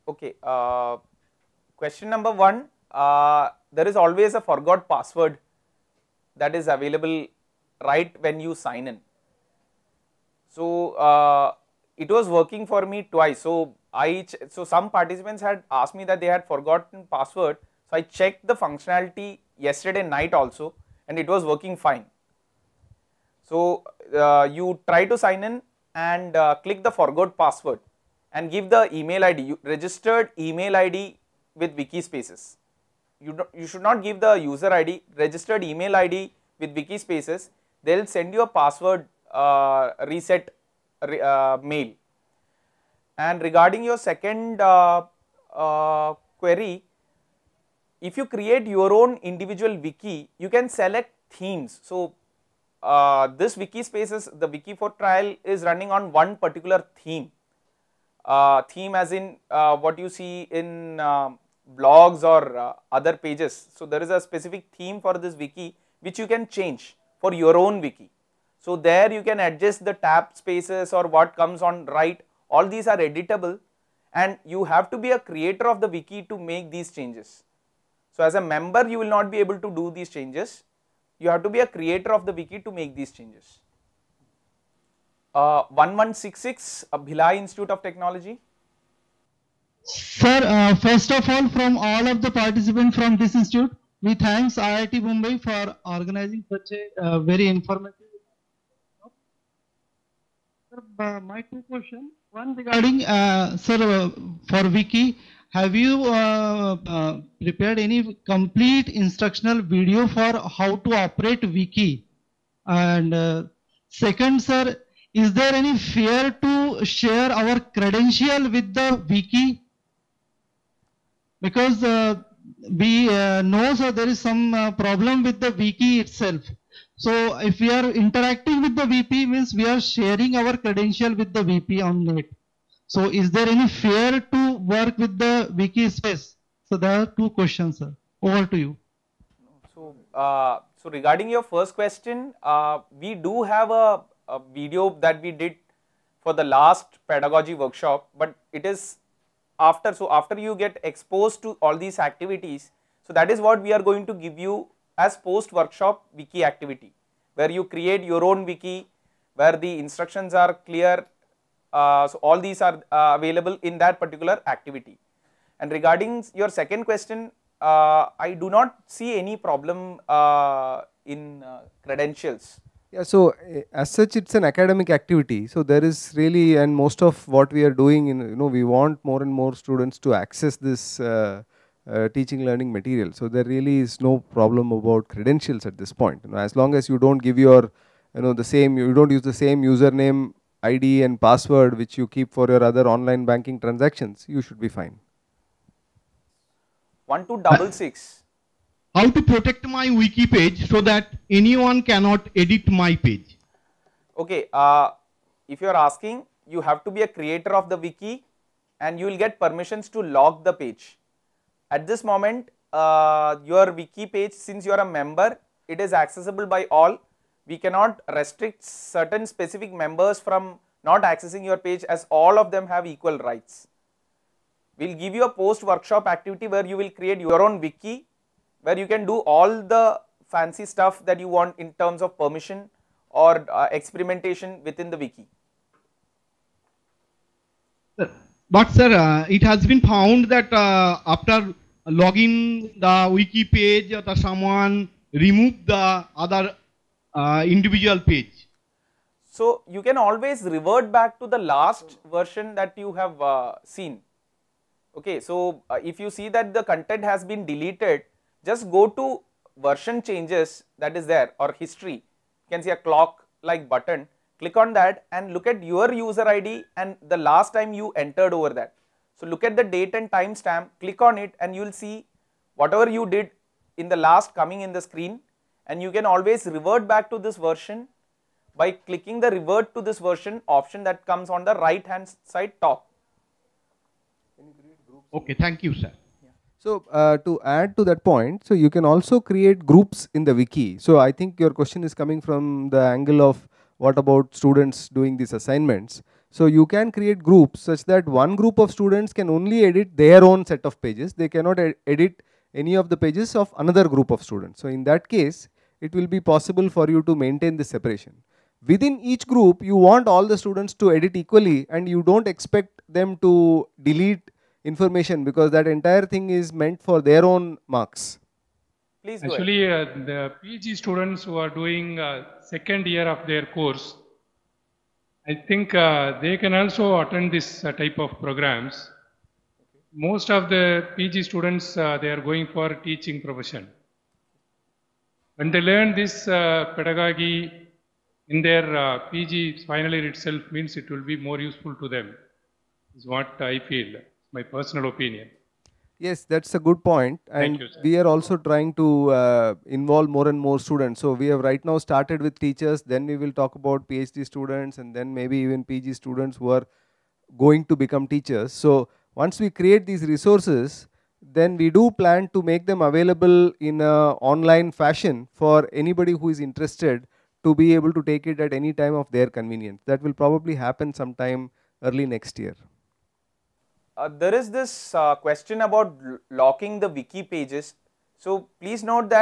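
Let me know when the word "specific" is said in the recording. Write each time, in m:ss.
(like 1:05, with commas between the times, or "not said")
1:04, 3:39.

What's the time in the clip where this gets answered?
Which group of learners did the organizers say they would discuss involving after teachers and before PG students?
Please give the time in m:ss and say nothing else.
5:53.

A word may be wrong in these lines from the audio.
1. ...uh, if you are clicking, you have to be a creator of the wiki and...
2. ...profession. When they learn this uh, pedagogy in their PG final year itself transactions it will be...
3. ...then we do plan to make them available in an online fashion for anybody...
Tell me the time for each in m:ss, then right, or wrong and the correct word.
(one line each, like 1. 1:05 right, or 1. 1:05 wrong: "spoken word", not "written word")
1. 3:24 wrong: "asking", not "clicking"
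2. 5:33 wrong: "means", not "transactions"
3. 6:01 right.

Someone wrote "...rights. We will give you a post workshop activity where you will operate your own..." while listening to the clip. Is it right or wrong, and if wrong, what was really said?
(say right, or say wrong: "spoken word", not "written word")
wrong: "create", not "operate".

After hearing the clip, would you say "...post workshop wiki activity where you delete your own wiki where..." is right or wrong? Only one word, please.
wrong.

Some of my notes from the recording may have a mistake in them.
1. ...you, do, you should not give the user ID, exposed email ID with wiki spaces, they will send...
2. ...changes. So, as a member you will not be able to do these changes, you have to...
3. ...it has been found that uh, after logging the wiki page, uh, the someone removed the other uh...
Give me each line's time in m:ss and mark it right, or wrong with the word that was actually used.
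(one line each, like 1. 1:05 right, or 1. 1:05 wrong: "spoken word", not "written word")
1. 0:33 wrong: "registered", not "exposed"
2. 1:16 right
3. 3:59 right.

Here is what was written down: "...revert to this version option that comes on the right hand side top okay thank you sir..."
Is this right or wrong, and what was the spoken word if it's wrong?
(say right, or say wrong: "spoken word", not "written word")
right.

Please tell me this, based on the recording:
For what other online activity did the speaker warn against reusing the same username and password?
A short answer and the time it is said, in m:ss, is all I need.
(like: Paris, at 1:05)
online banking, at 3:12.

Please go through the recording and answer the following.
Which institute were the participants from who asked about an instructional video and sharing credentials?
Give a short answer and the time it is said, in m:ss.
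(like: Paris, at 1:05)
Bhilai Institute of Technology, at 1:26.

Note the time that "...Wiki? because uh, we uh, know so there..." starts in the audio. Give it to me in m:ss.
1:59.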